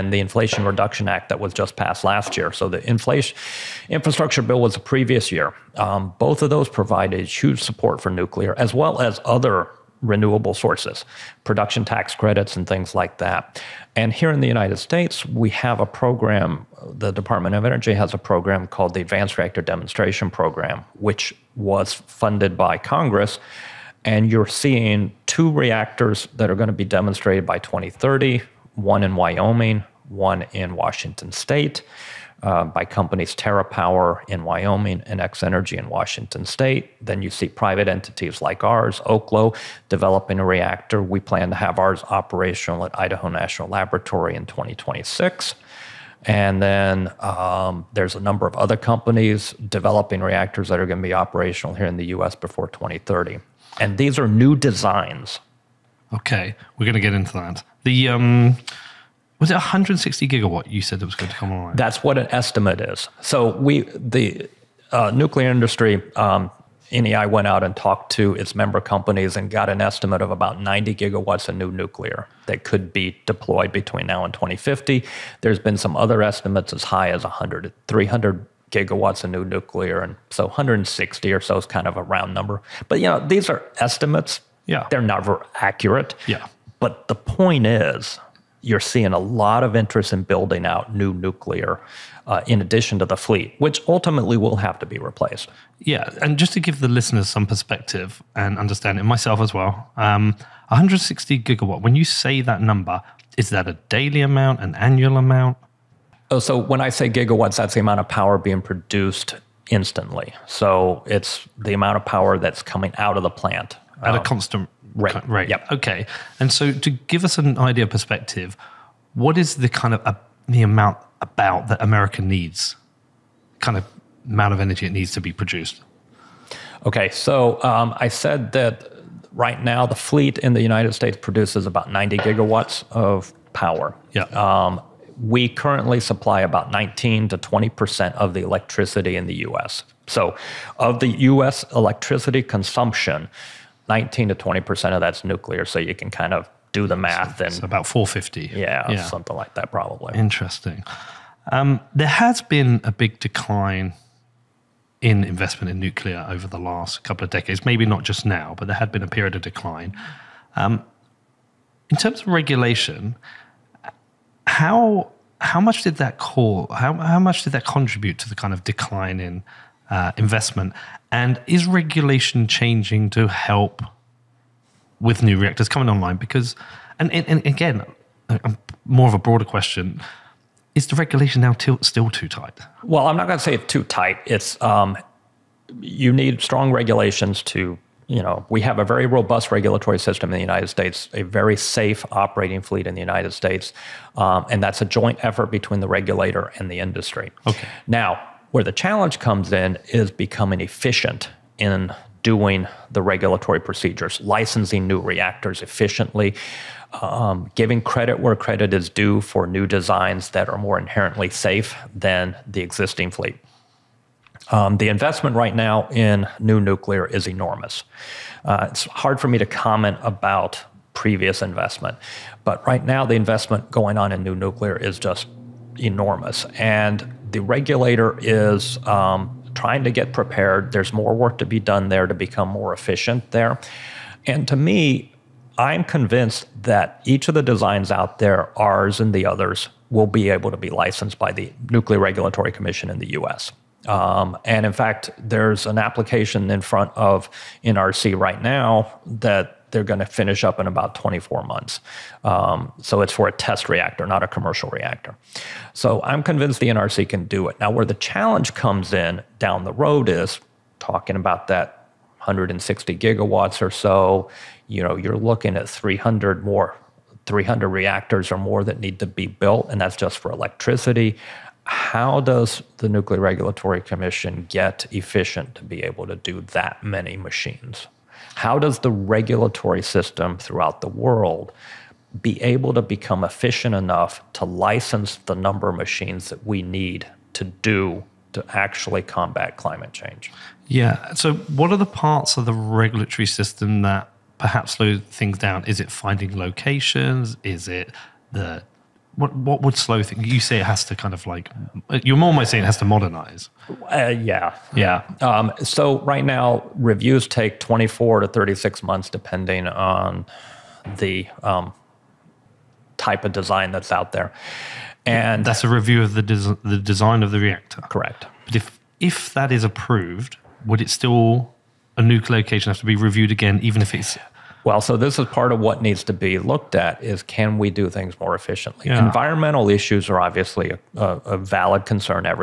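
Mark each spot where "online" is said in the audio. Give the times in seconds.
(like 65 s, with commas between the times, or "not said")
61 s, 175 s.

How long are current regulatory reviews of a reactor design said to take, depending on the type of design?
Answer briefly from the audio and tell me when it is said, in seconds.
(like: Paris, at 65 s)
24 to 36 months, at 307 s.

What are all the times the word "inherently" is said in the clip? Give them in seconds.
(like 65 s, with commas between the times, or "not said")
210 s.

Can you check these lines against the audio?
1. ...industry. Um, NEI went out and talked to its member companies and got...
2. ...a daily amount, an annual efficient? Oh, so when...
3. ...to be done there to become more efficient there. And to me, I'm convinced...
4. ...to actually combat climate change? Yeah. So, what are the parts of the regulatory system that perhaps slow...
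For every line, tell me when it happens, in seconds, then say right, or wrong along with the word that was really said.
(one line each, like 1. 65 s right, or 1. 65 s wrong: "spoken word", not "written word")
1. 65 s right
2. 103 s wrong: "amount", not "efficient"
3. 231 s right
4. 288 s right.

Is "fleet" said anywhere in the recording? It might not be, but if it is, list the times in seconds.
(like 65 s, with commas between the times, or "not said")
93 s, 129 s, 192 s, 213 s.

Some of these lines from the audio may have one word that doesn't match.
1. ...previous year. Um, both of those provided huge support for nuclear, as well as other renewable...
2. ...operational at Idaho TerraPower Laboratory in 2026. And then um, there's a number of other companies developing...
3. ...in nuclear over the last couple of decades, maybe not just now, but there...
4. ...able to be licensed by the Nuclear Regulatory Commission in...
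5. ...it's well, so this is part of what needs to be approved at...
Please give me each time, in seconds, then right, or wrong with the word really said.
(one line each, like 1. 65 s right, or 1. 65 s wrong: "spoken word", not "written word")
1. 4 s right
2. 42 s wrong: "National", not "TerraPower"
3. 155 s right
4. 240 s right
5. 323 s wrong: "looked", not "approved".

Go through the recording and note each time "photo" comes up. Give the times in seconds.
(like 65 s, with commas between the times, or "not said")
not said.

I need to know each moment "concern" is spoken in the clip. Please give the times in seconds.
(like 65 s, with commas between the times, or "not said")
331 s.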